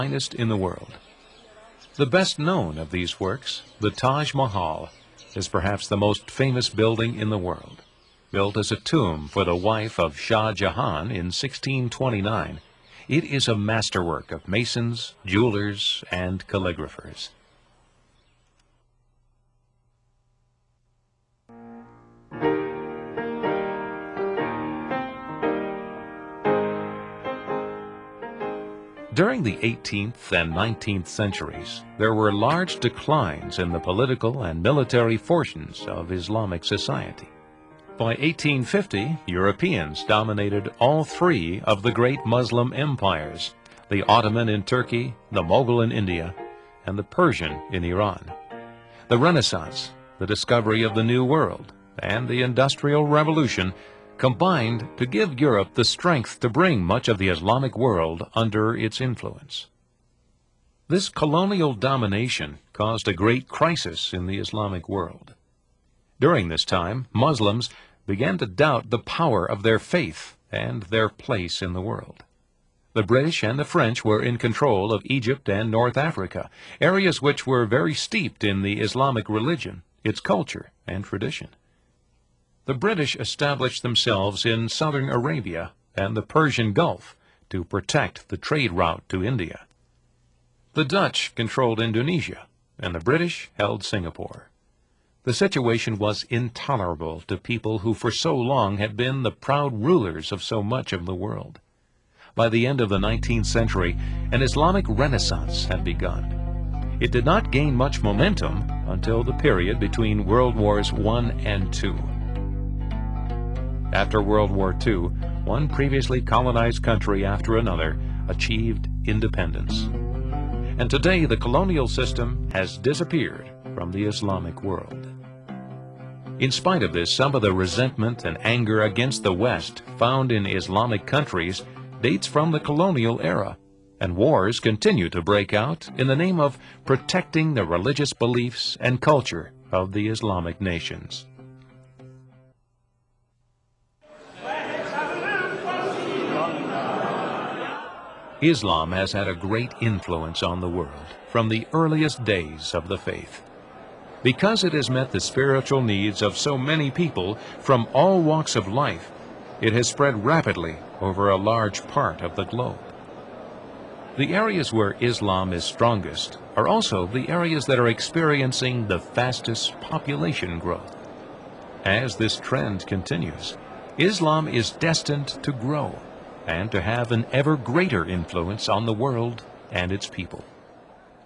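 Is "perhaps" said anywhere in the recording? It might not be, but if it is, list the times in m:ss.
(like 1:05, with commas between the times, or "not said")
0:05.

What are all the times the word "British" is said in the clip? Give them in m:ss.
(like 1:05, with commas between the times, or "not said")
1:13, 1:22, 1:33.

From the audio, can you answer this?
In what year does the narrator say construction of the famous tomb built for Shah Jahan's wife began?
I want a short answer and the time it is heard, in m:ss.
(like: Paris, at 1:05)
1629, at 0:11.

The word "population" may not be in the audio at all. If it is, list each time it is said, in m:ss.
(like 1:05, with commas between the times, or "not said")
2:49.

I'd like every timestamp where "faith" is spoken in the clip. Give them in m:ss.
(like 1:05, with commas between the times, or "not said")
1:09, 2:32.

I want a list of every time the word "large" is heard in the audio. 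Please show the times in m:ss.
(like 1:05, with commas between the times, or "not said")
0:32, 2:41.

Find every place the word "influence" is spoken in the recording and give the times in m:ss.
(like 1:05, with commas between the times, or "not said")
0:59, 2:29, 2:58.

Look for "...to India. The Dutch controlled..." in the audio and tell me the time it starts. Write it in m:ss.
1:29.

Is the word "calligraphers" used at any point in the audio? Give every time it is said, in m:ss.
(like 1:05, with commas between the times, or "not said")
0:16.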